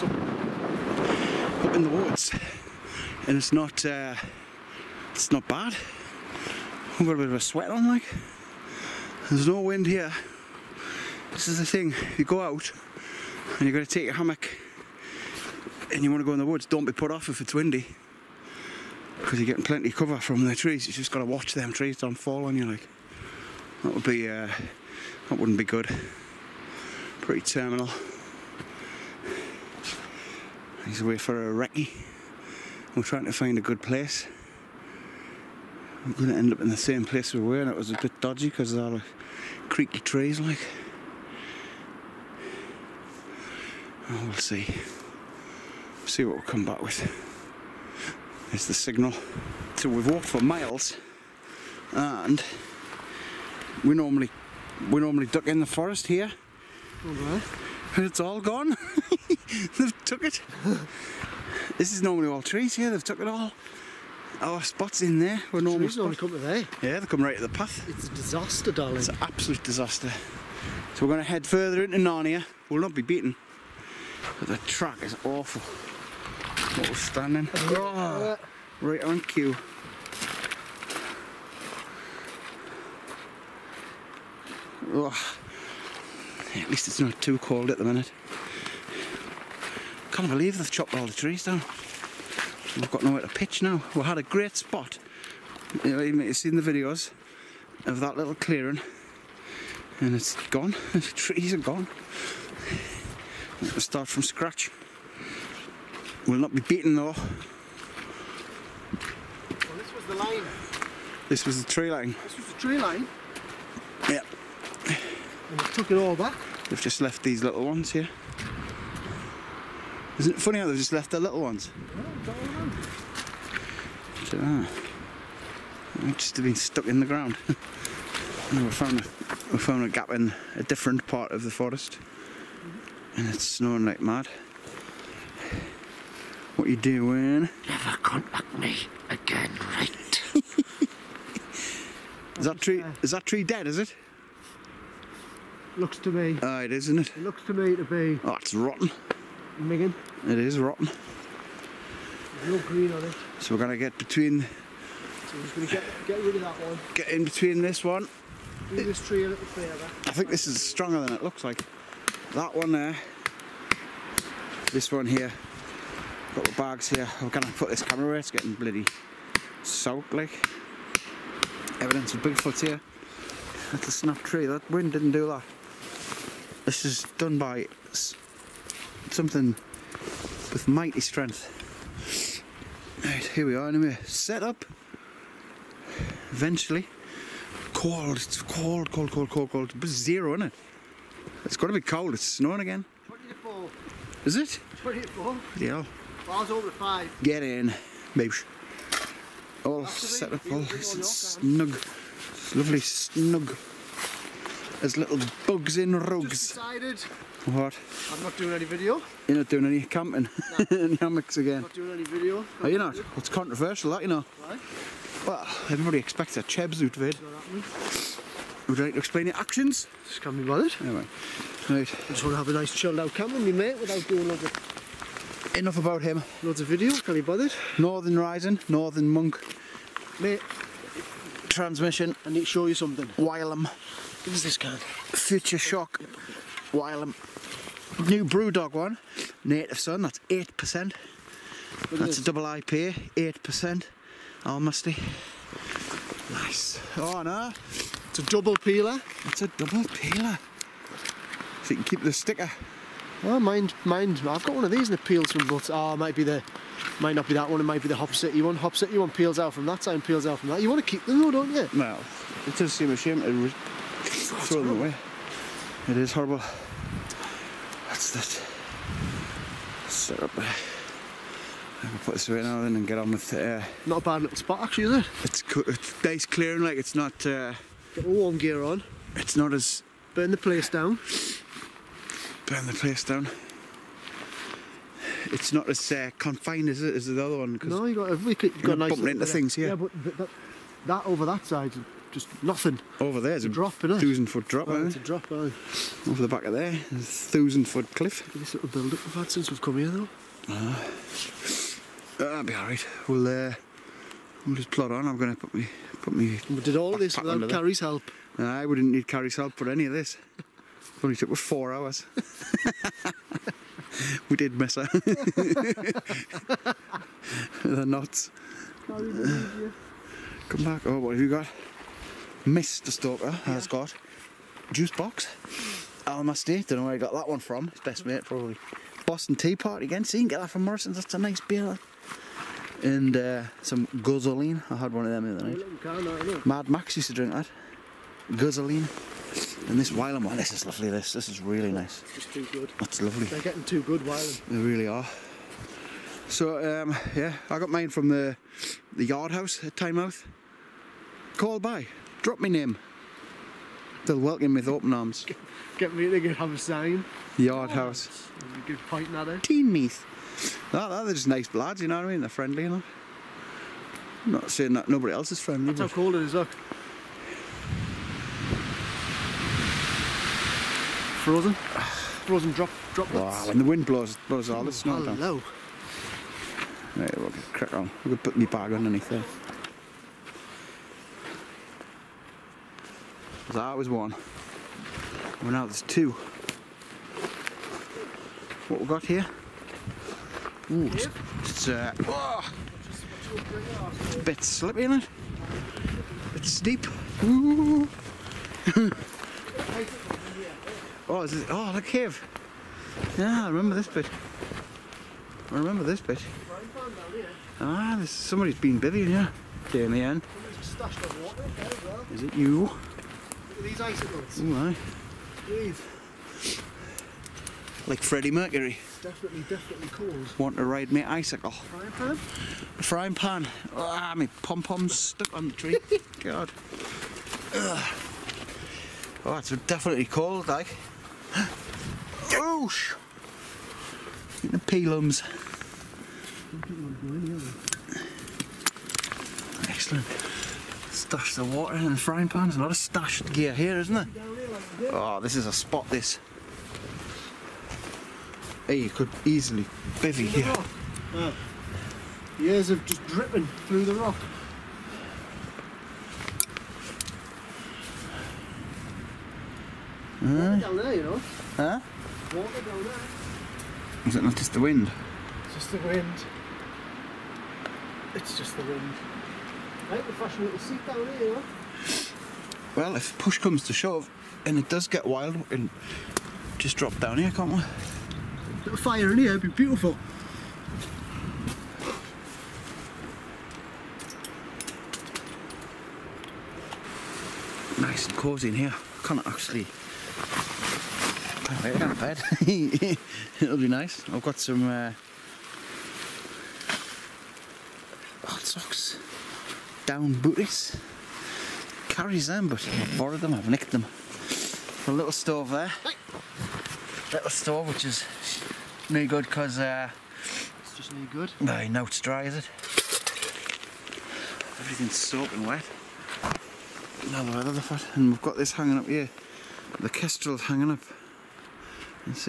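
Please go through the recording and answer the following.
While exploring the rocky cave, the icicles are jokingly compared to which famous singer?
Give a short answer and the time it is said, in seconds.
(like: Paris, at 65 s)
Freddie Mercury, at 418 s.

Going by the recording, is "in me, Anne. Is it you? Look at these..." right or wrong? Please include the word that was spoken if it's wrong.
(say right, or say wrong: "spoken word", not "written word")
right.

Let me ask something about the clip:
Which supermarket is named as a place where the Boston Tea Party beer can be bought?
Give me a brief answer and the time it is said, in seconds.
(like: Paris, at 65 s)
Morrison's, at 330 s.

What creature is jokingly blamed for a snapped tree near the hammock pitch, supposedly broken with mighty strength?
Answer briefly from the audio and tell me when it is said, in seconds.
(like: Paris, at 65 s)
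Bigfoot, at 172 s.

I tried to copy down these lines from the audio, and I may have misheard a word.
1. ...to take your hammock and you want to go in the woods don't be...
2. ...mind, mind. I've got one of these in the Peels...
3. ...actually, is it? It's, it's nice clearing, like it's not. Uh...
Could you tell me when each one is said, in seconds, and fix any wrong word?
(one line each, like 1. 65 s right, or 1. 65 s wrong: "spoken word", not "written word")
1. 13 s right
2. 253 s right
3. 274 s right.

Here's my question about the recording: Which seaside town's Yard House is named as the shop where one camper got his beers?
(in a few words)
Tynemouth.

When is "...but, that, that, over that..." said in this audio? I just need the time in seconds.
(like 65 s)
289 s.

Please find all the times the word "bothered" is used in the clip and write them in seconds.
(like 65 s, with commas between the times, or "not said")
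220 s, 227 s.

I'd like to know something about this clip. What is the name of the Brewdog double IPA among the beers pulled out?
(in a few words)
Native Sun.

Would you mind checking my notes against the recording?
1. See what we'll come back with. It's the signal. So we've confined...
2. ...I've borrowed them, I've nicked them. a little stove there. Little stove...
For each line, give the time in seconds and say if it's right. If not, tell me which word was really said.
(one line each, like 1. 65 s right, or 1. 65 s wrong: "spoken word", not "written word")
1. 46 s wrong: "walked", not "confined"
2. 502 s right.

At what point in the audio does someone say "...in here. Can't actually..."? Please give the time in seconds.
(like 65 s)
488 s.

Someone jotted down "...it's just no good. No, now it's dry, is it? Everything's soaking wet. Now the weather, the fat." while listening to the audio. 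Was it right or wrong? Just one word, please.
right.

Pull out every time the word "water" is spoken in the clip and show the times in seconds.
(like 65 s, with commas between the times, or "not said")
441 s, 462 s.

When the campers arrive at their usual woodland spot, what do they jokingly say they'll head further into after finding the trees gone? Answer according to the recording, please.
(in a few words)
Narnia.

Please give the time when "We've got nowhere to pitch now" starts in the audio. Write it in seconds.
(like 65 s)
92 s.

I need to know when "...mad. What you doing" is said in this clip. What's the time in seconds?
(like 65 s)
134 s.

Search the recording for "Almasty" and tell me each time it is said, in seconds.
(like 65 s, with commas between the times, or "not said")
244 s, 326 s.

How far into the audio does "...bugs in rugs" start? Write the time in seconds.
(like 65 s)
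205 s.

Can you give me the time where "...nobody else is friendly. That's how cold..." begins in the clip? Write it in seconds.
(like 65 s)
364 s.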